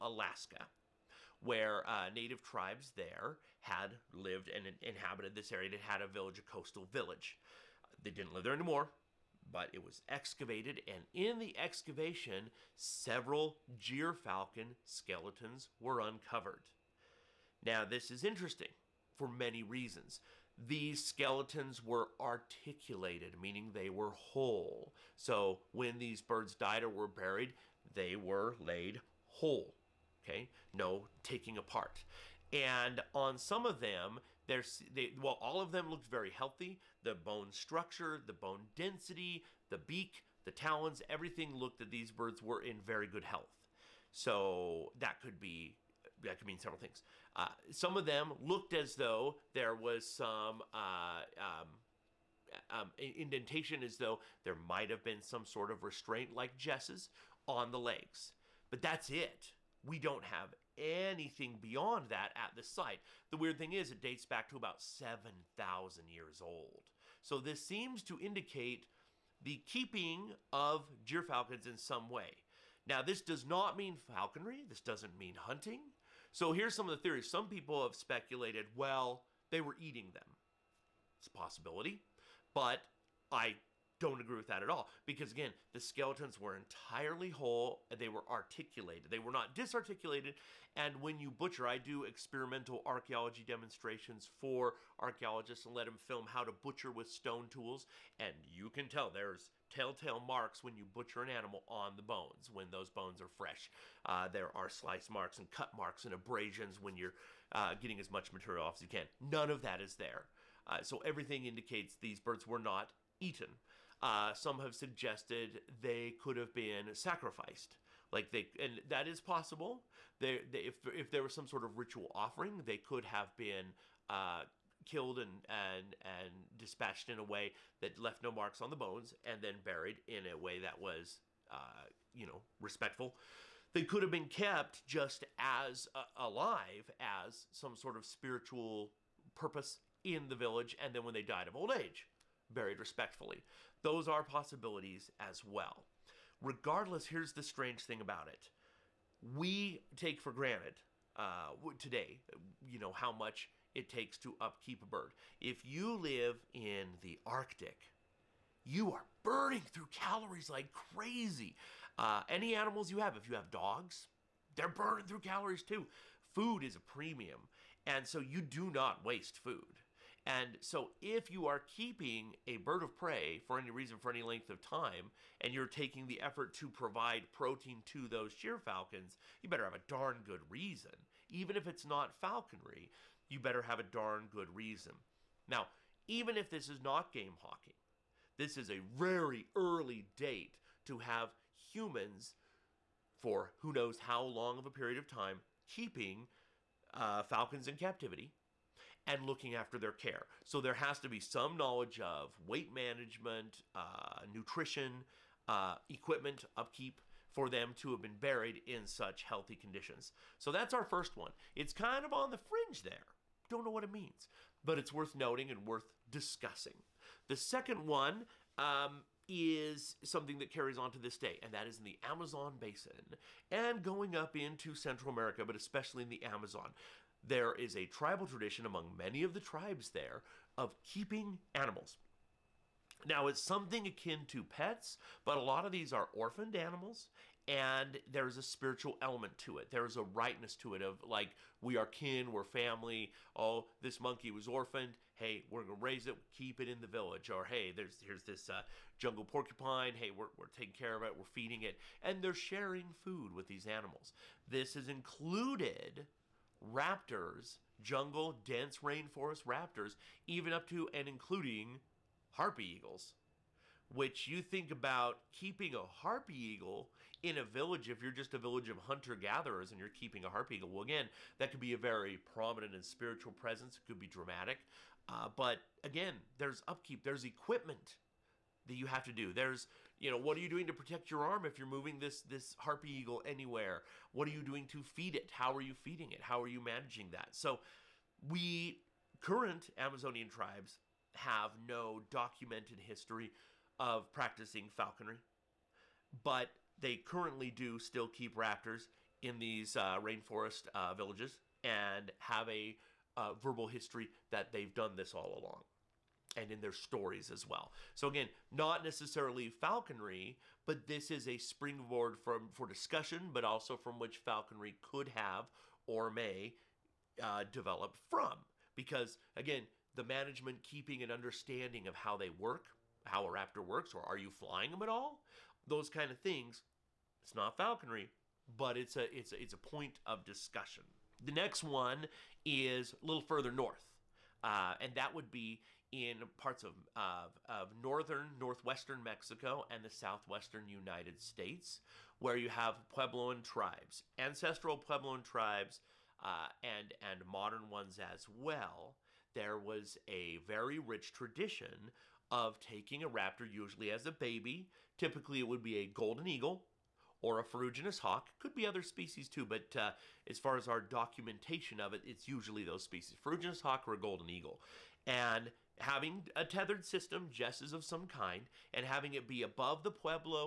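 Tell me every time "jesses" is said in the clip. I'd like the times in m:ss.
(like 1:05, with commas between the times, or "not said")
0:56, 6:07.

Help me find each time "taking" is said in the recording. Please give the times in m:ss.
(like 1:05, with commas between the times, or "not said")
0:31, 2:55, 4:10, 5:52.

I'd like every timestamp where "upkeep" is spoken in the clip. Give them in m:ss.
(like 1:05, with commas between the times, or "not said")
2:34, 3:26, 4:36.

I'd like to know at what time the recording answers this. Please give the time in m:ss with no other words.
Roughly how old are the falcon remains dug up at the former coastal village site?
1:04.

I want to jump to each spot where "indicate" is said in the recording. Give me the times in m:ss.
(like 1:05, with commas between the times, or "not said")
1:08, 1:51.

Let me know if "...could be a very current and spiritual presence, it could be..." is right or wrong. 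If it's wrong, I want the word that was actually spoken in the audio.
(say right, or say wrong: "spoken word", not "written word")
wrong: "prominent", not "current".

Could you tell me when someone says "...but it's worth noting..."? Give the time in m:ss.
3:34.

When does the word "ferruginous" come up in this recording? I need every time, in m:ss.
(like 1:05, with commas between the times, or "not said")
5:57, 6:03.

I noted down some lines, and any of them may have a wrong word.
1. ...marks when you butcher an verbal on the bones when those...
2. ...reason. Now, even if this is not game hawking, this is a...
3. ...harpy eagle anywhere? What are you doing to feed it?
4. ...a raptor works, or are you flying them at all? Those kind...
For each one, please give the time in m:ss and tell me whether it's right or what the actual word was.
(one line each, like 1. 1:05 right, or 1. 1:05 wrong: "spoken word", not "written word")
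1. 1:40 wrong: "animal", not "verbal"
2. 3:04 right
3. 4:42 right
4. 5:23 right.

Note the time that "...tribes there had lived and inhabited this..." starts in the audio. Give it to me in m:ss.
0:02.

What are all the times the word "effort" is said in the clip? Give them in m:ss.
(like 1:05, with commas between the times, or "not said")
2:56.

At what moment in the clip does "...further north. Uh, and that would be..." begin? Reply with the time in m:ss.
5:33.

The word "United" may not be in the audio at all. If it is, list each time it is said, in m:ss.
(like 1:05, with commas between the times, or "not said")
5:40.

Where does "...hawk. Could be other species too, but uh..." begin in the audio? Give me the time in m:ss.
5:57.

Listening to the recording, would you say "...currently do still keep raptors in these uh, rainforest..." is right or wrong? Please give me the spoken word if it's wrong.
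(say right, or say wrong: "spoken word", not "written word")
right.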